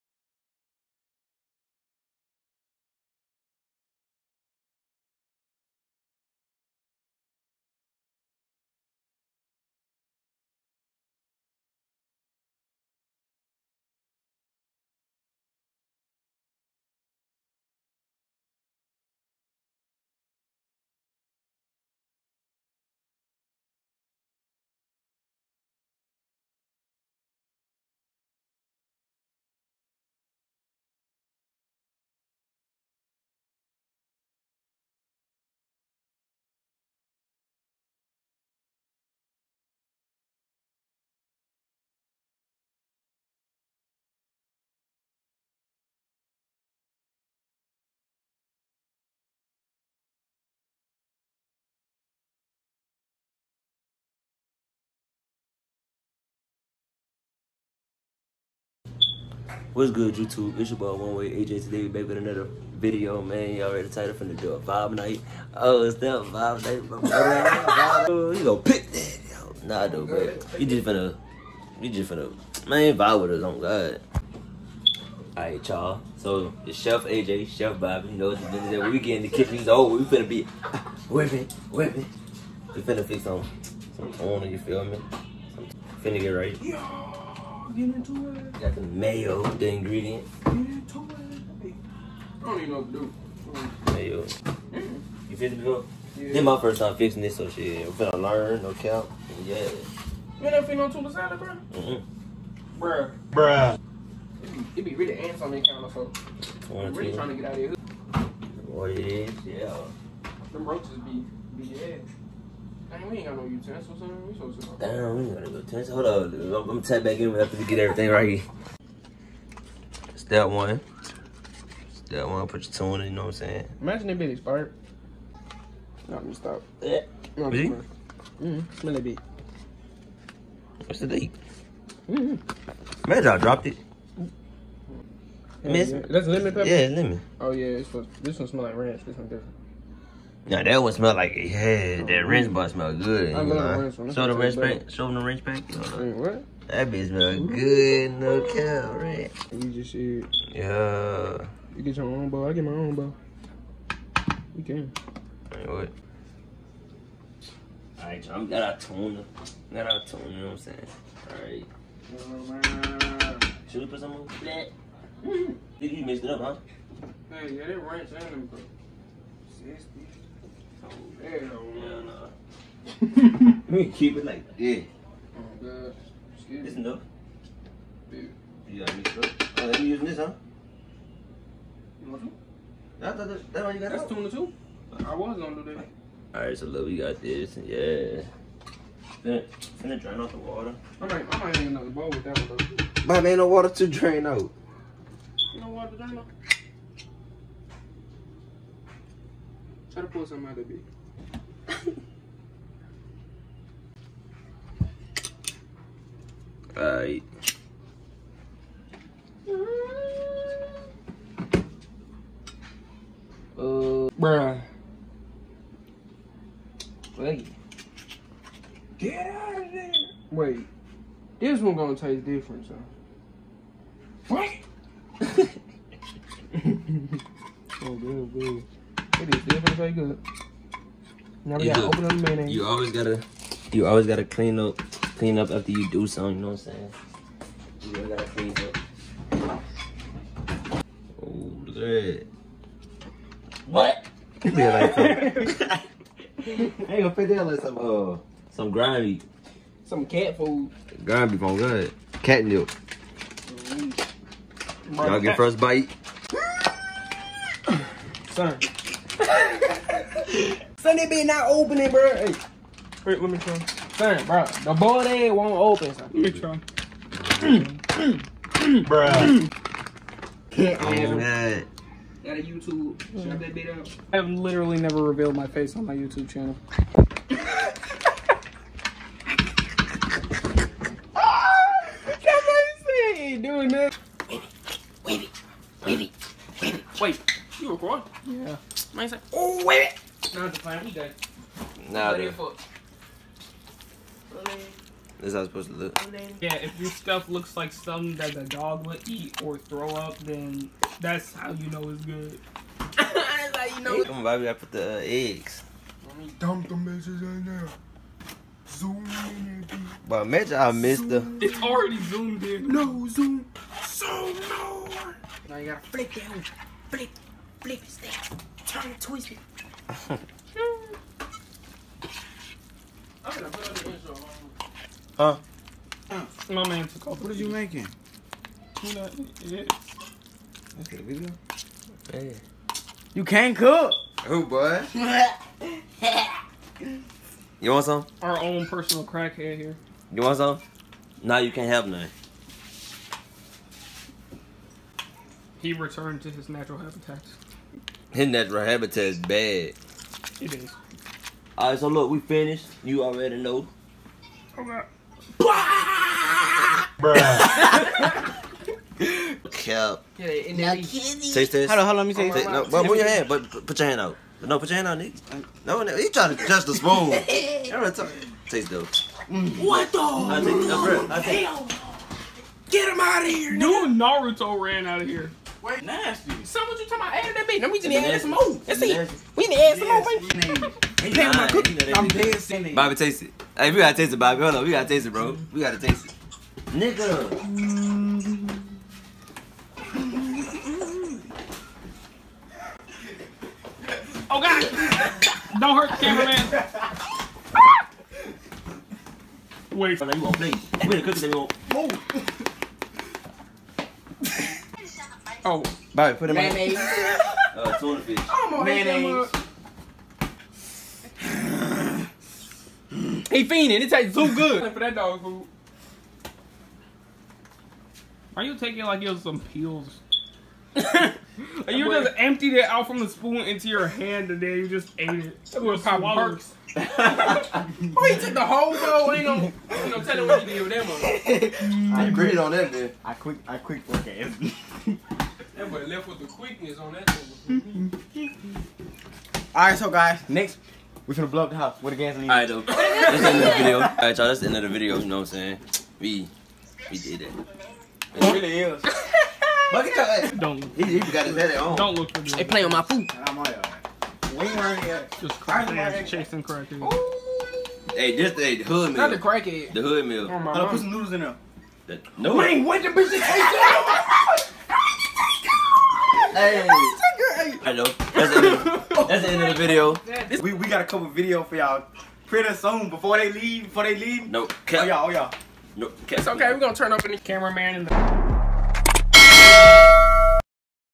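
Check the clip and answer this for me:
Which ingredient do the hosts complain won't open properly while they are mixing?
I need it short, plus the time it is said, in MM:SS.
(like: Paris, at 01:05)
boiled egg, at 04:24.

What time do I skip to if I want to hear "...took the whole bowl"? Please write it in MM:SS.
07:08.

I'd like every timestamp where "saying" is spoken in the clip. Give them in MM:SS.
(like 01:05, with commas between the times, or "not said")
02:03, 02:40, 03:56, 07:25.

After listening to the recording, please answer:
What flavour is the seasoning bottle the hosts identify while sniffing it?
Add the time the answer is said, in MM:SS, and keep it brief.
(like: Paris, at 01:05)
lemon pepper, at 02:16.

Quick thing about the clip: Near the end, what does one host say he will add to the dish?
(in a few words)
noodles.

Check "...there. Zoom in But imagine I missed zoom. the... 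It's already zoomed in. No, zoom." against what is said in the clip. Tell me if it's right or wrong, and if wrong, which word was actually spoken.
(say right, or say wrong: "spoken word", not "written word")
right.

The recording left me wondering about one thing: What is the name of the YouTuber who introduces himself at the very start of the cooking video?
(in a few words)
One Way AJ.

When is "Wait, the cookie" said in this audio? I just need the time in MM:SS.
06:40.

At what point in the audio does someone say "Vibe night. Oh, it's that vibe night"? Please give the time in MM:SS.
01:04.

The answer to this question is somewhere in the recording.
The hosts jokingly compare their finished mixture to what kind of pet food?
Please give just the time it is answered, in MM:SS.
04:10.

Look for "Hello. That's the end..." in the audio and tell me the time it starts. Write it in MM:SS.
07:47.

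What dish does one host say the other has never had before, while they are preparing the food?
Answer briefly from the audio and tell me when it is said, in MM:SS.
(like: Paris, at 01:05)
tuna salad, at 01:40.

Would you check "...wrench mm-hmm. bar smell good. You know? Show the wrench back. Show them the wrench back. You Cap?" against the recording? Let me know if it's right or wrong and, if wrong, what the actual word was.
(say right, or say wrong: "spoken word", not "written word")
wrong: "What", not "Cap".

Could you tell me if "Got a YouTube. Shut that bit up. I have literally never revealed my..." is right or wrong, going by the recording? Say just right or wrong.
right.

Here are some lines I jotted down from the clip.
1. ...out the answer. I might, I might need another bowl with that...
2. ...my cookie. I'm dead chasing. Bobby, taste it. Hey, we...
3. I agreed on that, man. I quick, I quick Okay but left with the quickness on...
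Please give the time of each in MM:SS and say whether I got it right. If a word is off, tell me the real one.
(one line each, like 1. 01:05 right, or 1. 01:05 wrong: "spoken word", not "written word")
1. 03:10 wrong: "water", not "answer"
2. 06:21 wrong: "sinning", not "chasing"
3. 07:11 right.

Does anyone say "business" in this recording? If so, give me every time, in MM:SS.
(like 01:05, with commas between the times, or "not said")
01:18.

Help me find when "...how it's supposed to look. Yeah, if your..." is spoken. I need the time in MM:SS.
04:55.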